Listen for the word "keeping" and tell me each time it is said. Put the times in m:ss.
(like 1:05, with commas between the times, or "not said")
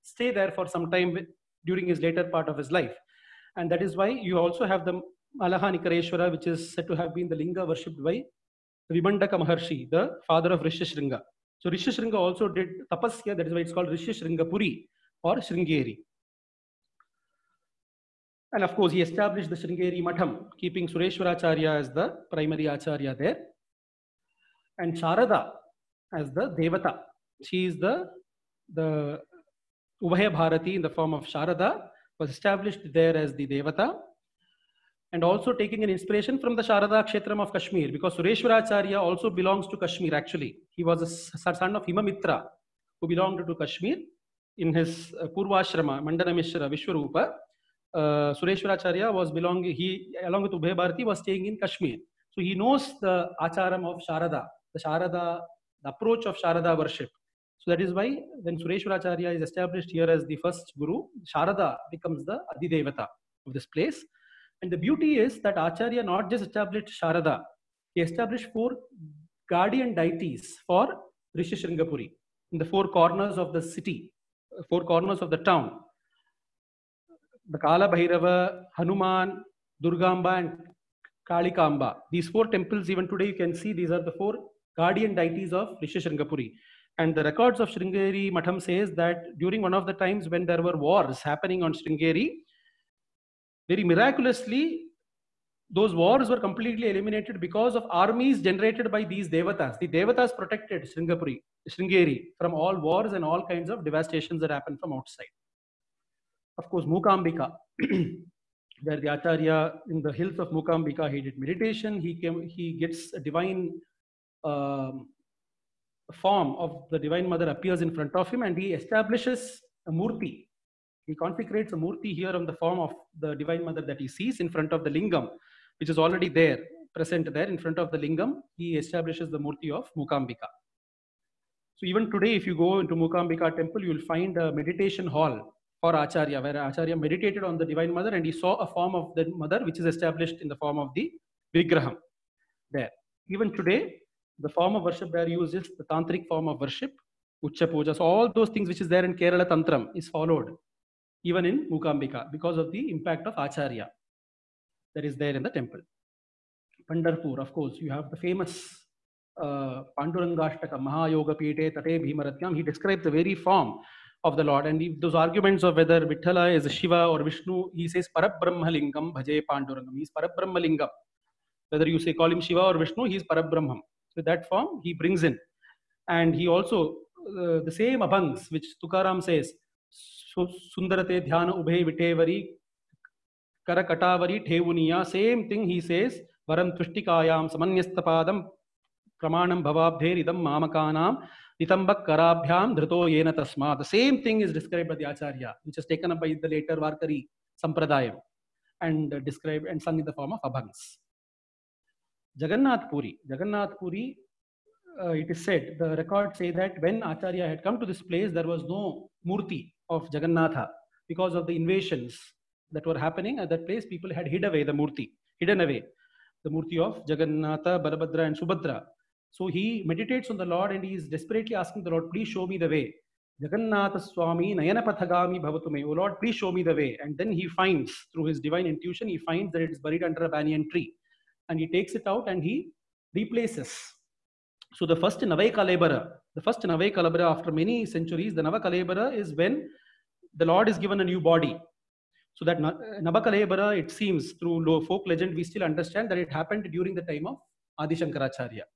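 0:20.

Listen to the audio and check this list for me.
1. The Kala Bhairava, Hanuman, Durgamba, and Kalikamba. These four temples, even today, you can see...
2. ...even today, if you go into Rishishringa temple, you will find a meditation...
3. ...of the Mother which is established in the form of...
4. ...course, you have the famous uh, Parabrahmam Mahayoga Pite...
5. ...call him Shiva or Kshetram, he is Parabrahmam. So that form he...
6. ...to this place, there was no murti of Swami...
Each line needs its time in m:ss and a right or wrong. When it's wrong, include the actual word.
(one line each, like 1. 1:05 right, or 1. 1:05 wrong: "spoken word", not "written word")
1. 1:17 right
2. 2:11 wrong: "Mukambika", not "Rishishringa"
3. 2:18 right
4. 2:37 wrong: "Pandurangashtaka", not "Parabrahmam"
5. 2:52 wrong: "Vishnu", not "Kshetram"
6. 3:27 wrong: "Jagannatha", not "Swami".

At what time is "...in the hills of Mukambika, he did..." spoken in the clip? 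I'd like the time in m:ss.
1:49.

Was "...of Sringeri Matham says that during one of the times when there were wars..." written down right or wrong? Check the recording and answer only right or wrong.
right.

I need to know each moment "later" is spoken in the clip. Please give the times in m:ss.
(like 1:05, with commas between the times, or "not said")
0:02, 3:16.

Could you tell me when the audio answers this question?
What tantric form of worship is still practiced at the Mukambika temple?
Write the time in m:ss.
2:27.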